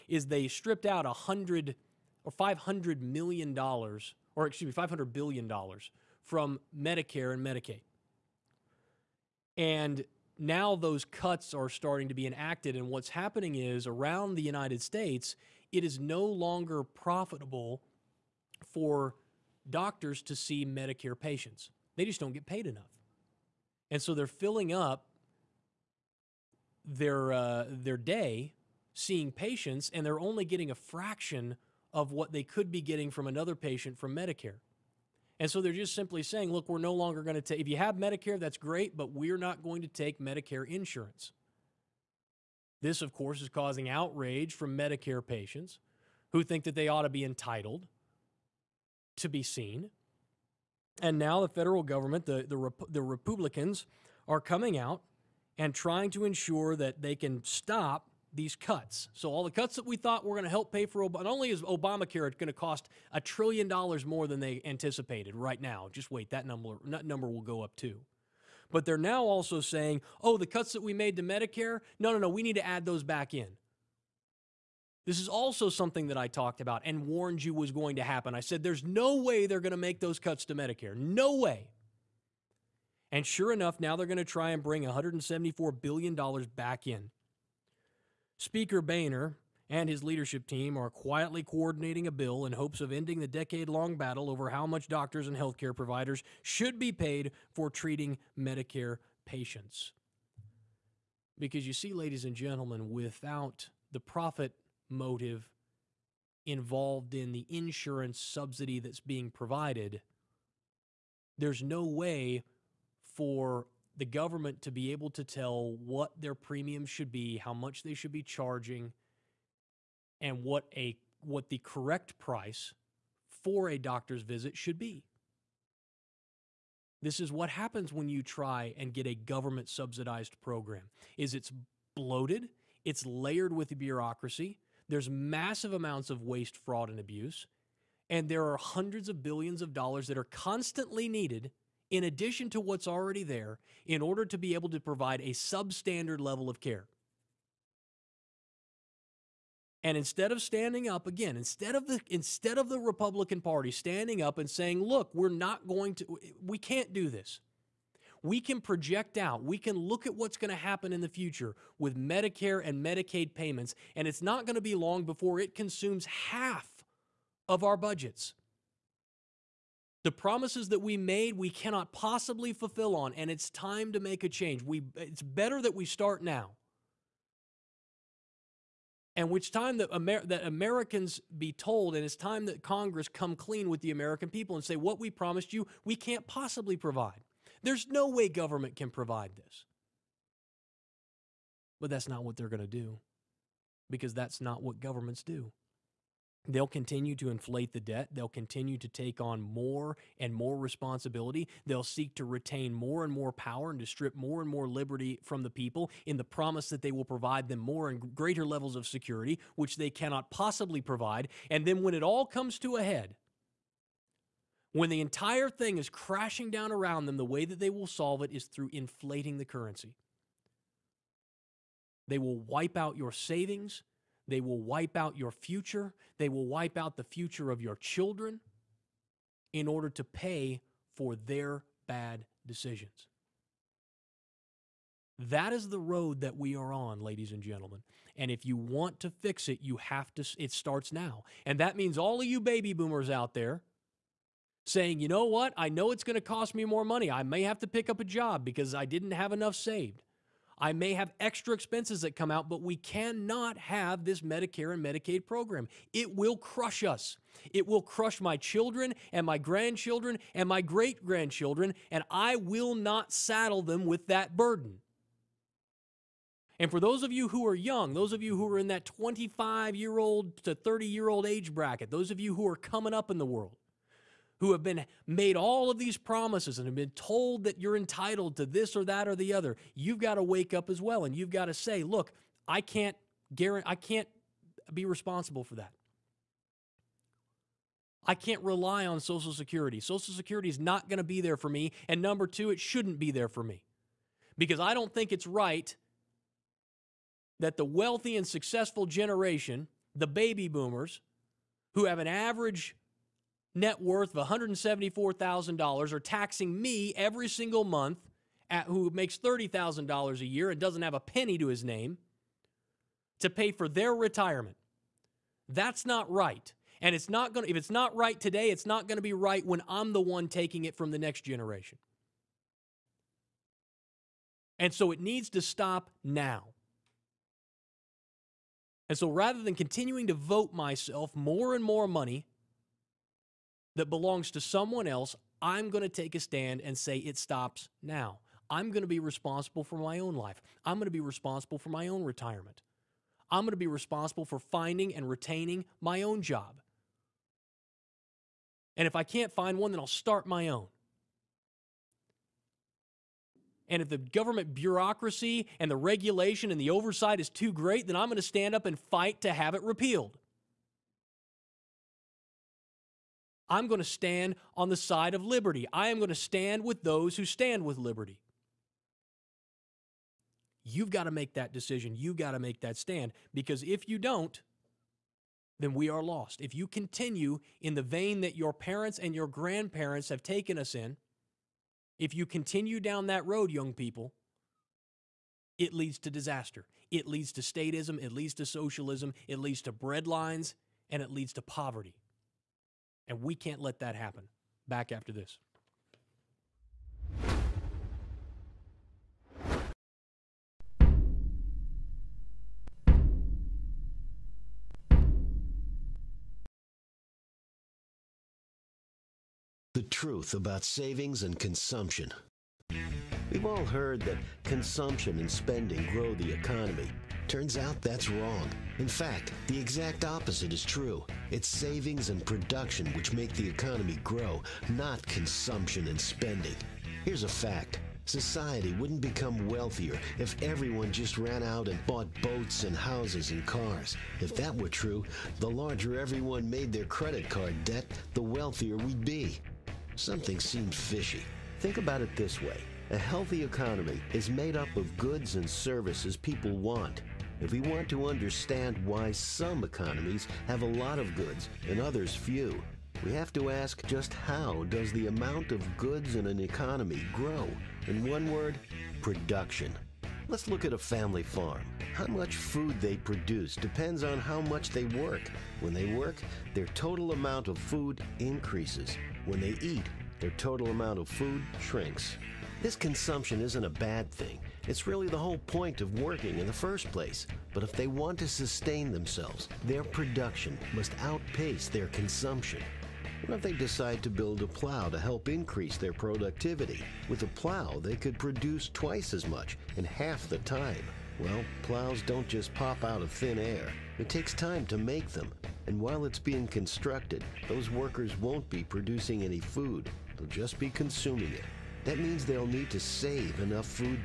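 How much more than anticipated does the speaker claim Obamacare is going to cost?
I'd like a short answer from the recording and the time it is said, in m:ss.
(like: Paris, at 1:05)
a trillion dollars, at 1:03.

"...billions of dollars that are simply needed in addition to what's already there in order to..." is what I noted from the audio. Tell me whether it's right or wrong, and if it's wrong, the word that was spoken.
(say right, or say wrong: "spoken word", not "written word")
wrong: "constantly", not "simply".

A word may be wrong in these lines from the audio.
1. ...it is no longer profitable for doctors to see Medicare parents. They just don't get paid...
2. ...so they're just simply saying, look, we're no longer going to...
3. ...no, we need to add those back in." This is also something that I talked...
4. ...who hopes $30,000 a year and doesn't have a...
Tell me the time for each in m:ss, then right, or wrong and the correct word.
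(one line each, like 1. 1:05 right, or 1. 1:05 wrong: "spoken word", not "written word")
1. 0:15 wrong: "patients", not "parents"
2. 0:35 right
3. 1:12 right
4. 5:08 wrong: "makes", not "hopes".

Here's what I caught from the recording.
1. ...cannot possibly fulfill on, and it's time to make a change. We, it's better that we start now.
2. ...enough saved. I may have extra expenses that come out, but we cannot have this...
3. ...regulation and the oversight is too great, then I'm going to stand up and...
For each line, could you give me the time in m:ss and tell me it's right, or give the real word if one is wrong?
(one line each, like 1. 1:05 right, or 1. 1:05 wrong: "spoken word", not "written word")
1. 2:51 right
2. 4:09 right
3. 5:55 right.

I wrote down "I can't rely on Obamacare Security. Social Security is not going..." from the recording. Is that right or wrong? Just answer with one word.
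wrong.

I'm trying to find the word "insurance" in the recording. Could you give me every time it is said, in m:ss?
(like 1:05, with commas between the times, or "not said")
0:40, 1:47.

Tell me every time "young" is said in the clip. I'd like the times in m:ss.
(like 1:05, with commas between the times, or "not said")
4:27, 6:23.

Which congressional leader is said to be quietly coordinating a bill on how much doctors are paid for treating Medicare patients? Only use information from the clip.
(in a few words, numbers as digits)
Speaker Boehner.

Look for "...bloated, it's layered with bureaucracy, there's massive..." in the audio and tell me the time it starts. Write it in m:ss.
2:11.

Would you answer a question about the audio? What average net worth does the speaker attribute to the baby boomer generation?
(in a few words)
$174,000.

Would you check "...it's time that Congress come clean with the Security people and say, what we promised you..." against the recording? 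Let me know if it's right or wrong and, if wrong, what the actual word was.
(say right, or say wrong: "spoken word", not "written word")
wrong: "American", not "Security".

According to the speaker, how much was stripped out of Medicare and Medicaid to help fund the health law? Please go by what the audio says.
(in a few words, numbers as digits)
$500 billion.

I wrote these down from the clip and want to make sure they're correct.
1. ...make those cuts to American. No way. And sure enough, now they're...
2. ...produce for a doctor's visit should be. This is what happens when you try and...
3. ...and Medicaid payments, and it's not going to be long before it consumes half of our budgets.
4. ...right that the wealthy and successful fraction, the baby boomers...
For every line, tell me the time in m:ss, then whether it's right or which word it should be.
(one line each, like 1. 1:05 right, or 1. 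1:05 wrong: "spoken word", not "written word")
1. 1:19 wrong: "Medicare", not "American"
2. 2:02 wrong: "price", not "produce"
3. 2:42 right
4. 4:55 wrong: "generation", not "fraction".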